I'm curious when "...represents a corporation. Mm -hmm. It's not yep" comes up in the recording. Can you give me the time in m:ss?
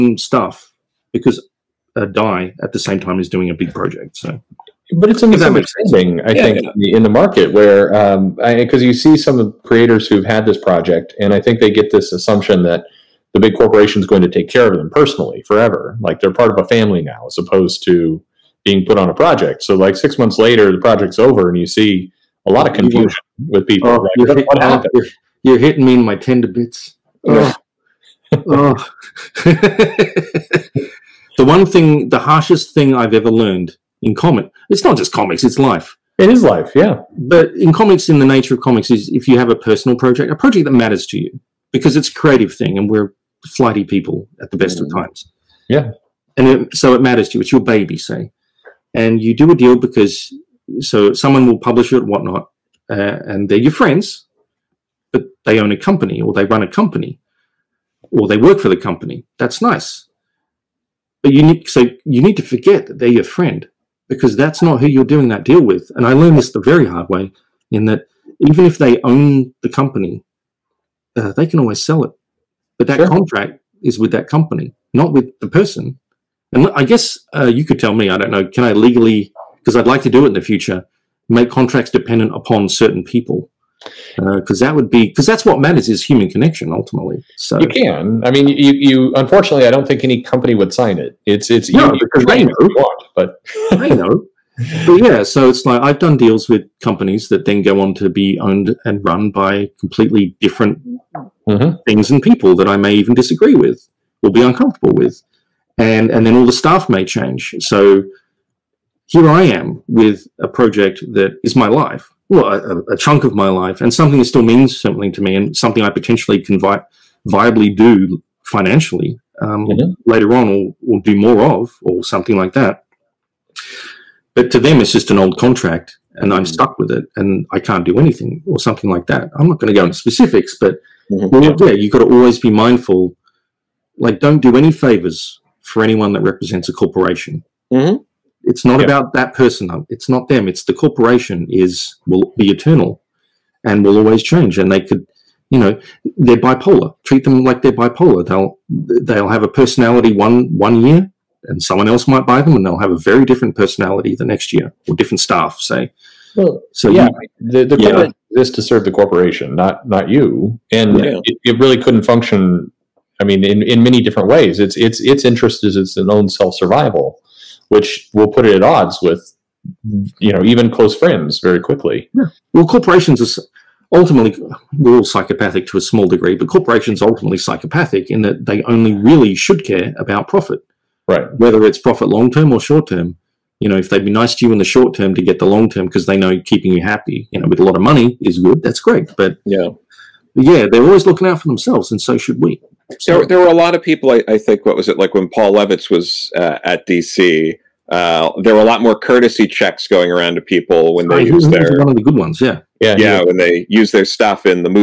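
2:16.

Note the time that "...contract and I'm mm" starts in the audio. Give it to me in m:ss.
2:05.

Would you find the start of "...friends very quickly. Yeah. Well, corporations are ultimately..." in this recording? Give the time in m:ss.
2:50.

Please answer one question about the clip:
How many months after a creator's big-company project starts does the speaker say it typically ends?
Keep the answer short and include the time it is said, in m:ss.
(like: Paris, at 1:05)
6, at 0:19.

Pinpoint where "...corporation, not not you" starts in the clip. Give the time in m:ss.
2:38.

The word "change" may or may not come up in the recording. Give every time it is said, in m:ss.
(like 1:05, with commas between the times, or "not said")
1:47, 2:24.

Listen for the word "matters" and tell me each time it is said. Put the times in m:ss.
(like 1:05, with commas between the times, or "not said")
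0:40, 0:47, 1:25.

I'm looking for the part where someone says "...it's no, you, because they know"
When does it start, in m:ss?
1:31.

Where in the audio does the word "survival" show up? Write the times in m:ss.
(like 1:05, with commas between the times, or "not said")
2:46.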